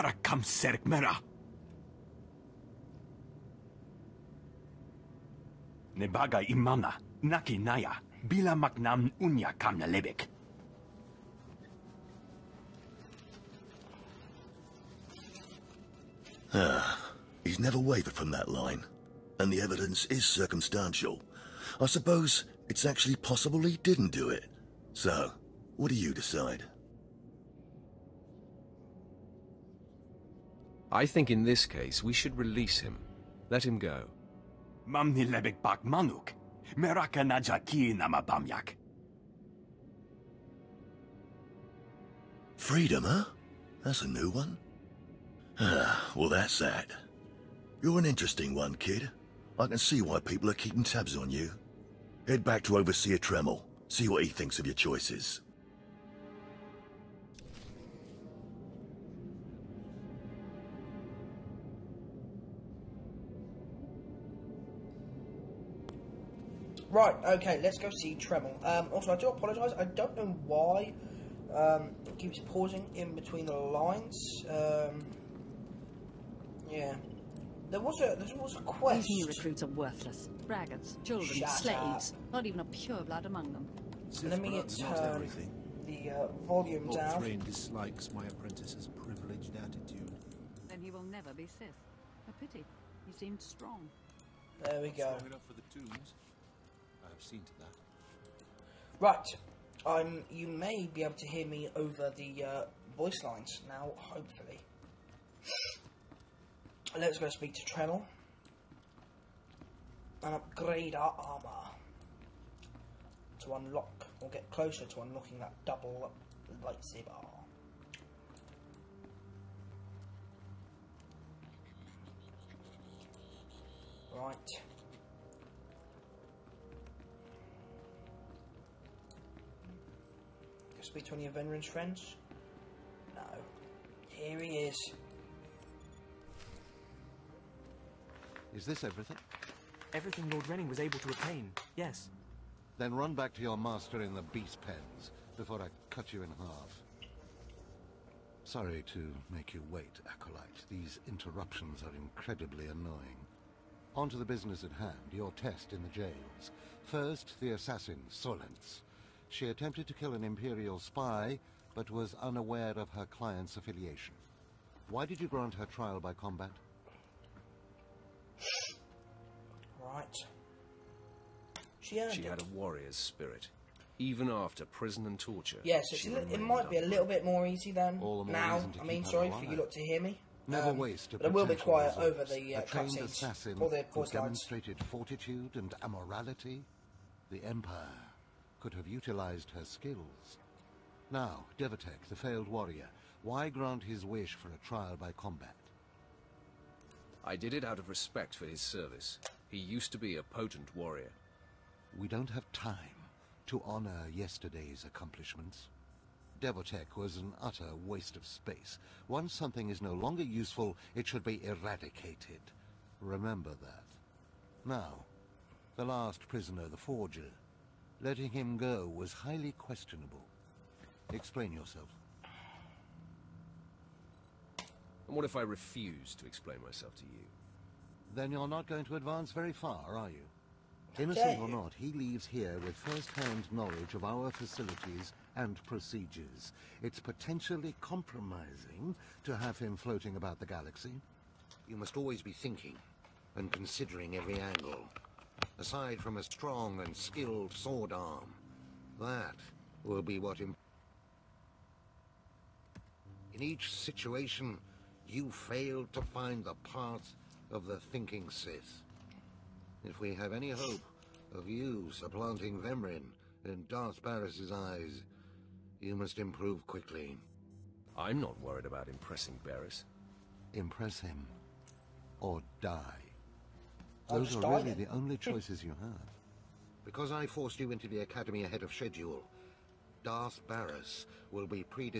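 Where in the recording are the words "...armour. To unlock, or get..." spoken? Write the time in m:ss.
1:51.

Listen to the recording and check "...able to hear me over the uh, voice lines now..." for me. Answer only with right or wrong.
right.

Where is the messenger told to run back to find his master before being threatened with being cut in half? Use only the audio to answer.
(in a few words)
the beast pens.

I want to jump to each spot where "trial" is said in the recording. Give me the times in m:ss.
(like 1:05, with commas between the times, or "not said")
2:45, 3:14.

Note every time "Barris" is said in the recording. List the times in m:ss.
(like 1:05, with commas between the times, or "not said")
4:24, 4:29, 4:40.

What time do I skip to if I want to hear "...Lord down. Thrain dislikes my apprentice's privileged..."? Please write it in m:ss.
1:26.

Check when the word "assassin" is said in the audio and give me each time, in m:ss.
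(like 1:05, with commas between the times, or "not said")
2:37, 3:03.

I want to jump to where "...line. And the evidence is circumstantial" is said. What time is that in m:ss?
0:18.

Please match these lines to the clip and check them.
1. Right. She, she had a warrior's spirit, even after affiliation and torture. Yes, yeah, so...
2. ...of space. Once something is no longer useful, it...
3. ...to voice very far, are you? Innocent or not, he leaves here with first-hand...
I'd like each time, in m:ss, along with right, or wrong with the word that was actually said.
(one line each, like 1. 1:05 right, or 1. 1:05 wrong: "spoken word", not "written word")
1. 2:49 wrong: "prison", not "affiliation"
2. 3:28 right
3. 3:48 wrong: "advance", not "voice".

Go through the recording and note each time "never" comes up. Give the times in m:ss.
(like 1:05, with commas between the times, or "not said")
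0:17, 1:31, 3:00.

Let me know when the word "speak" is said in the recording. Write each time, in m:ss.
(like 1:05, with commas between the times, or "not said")
1:47, 2:10.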